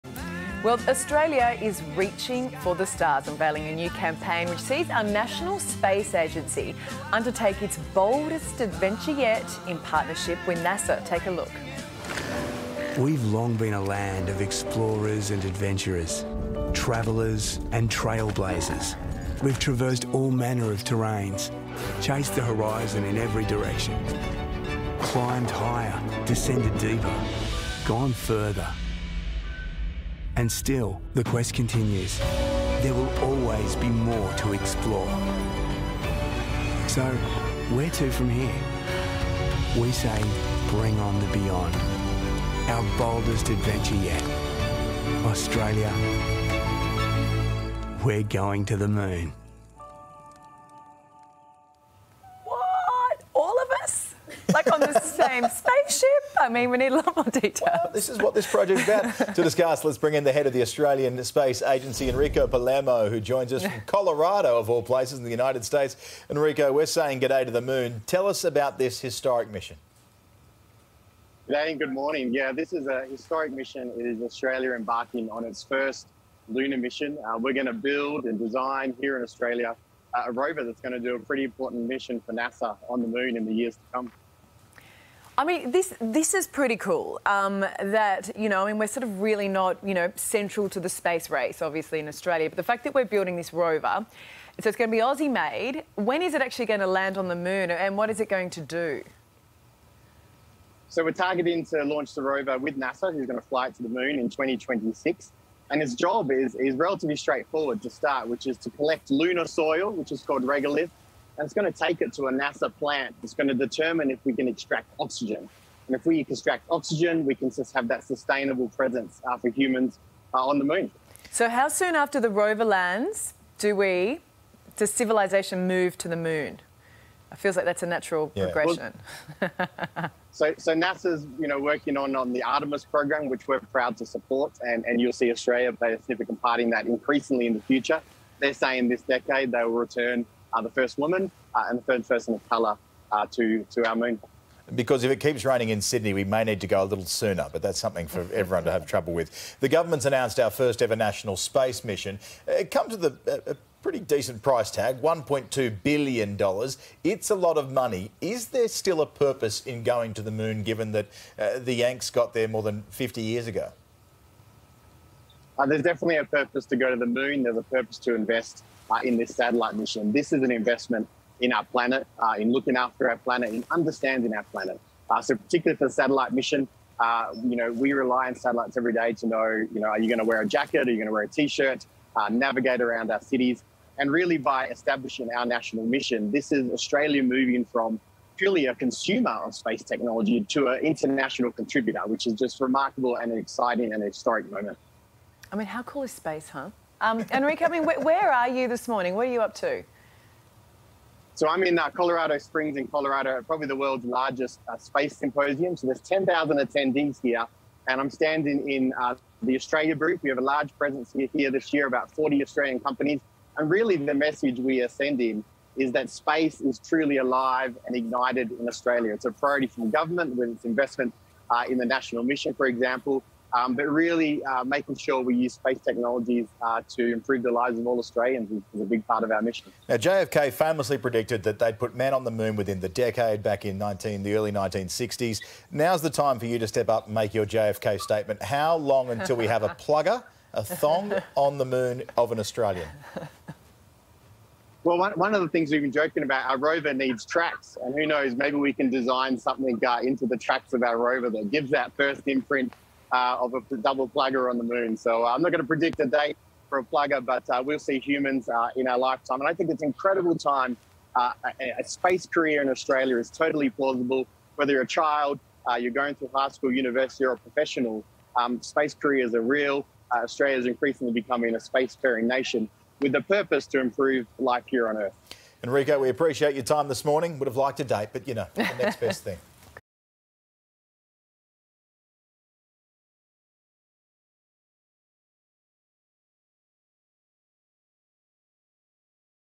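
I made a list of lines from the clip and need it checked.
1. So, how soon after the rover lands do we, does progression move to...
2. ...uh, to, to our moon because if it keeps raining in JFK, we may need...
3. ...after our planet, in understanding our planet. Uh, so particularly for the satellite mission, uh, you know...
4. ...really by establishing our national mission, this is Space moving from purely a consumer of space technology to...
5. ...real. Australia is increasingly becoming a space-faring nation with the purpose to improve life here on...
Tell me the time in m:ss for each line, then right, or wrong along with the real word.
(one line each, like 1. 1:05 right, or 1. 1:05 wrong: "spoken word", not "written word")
1. 2:01 wrong: "civilization", not "progression"
2. 2:23 wrong: "Sydney", not "JFK"
3. 2:52 right
4. 3:04 wrong: "Australia", not "Space"
5. 4:29 right.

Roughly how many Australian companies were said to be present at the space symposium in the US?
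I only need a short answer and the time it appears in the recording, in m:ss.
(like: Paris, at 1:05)
40, at 3:31.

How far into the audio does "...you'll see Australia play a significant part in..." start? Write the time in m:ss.
2:15.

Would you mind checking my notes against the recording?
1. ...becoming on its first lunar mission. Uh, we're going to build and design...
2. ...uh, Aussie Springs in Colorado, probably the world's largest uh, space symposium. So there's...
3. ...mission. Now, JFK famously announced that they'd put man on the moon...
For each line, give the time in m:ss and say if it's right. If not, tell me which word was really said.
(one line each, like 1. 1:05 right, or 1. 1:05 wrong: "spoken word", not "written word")
1. 1:14 wrong: "embarking", not "becoming"
2. 3:21 wrong: "Colorado", not "Aussie"
3. 3:49 wrong: "predicted", not "announced".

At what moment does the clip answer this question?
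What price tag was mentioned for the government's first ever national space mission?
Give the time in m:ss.
2:35.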